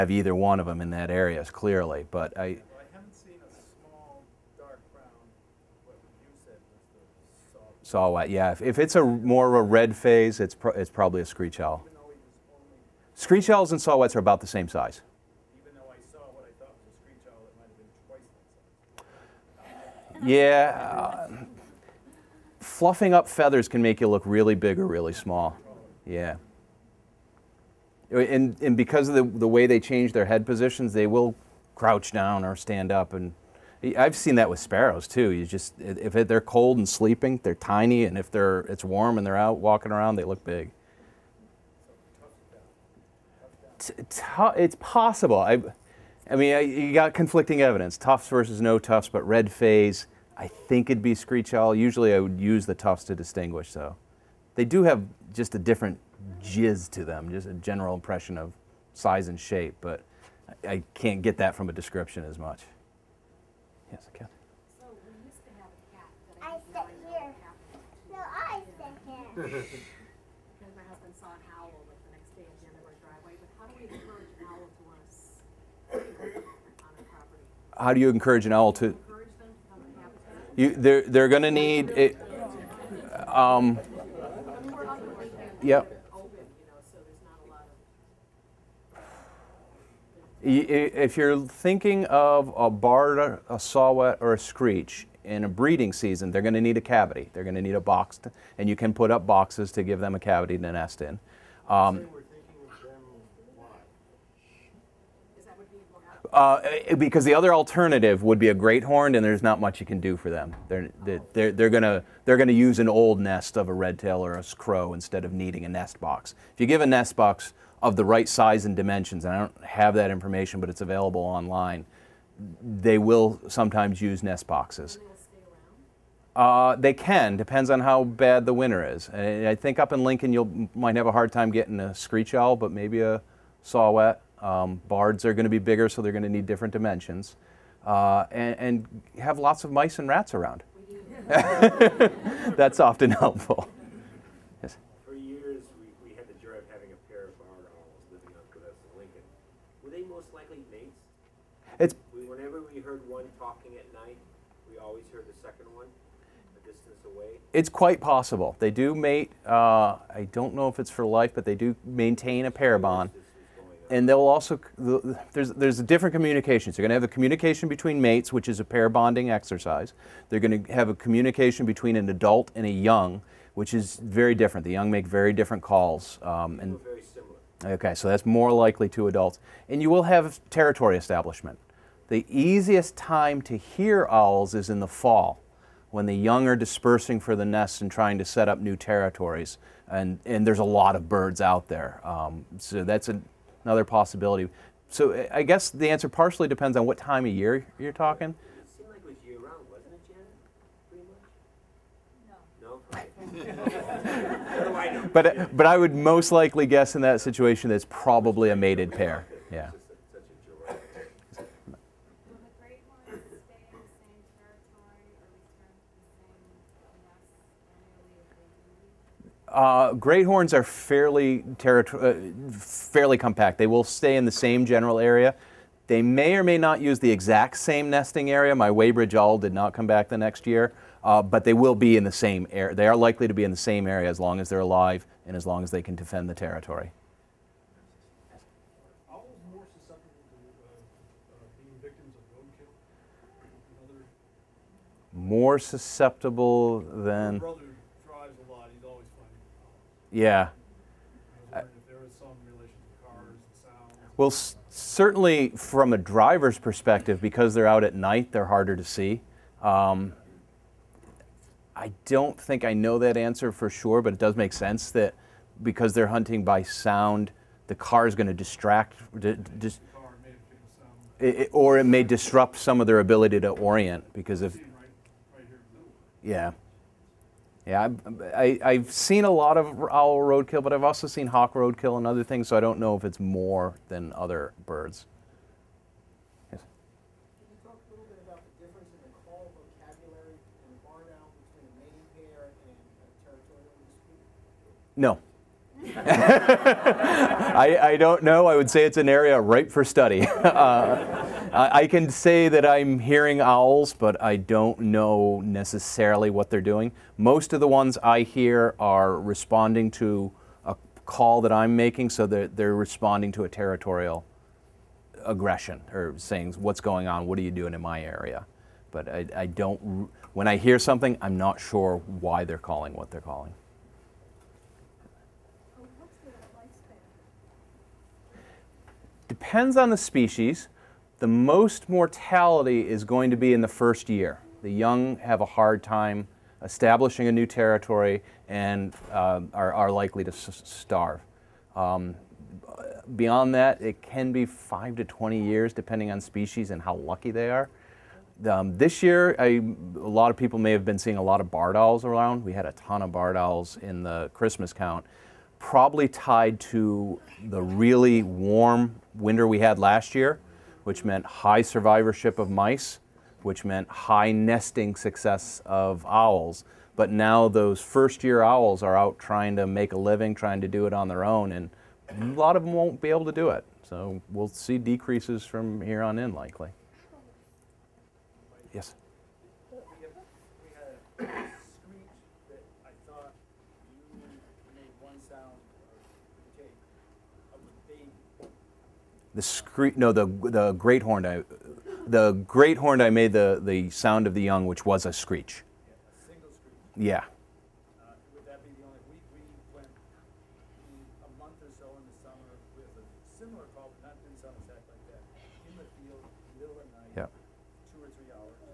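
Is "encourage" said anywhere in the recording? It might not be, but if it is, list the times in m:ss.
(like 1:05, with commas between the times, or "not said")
1:13, 1:18.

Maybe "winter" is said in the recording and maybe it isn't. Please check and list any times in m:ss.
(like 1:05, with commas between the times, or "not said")
2:08, 5:59.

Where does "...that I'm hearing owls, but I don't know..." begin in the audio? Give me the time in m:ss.
5:02.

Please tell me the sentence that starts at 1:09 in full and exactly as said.
Because my husband saw an owl like the next day at the end of our driveway.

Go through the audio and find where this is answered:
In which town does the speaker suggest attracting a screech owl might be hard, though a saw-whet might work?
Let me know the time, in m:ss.
2:10.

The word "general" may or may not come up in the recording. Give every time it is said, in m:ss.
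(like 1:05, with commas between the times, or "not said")
0:57, 3:44.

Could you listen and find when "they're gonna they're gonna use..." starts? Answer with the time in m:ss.
1:51.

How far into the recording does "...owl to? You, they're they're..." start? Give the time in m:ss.
1:18.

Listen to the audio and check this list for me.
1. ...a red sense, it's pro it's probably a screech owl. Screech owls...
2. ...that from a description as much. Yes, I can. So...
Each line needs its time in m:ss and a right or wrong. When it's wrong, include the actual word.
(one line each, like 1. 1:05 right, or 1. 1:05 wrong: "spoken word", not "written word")
1. 0:09 wrong: "phase", not "sense"
2. 1:01 right.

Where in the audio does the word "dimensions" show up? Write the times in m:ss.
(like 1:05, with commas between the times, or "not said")
1:58, 2:16.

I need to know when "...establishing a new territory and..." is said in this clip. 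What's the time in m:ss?
5:36.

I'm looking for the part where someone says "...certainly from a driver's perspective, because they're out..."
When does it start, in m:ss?
4:14.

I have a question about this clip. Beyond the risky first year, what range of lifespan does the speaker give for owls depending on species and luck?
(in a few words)
5 to 20 years.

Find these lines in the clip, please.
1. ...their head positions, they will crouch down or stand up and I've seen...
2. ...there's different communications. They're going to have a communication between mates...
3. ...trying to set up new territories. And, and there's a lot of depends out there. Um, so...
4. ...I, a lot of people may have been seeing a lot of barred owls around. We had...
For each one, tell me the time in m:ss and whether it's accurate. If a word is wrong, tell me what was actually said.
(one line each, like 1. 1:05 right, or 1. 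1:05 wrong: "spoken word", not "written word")
1. 0:30 right
2. 2:45 right
3. 3:07 wrong: "birds", not "depends"
4. 5:49 right.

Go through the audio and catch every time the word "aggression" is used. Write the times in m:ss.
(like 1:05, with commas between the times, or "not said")
5:15.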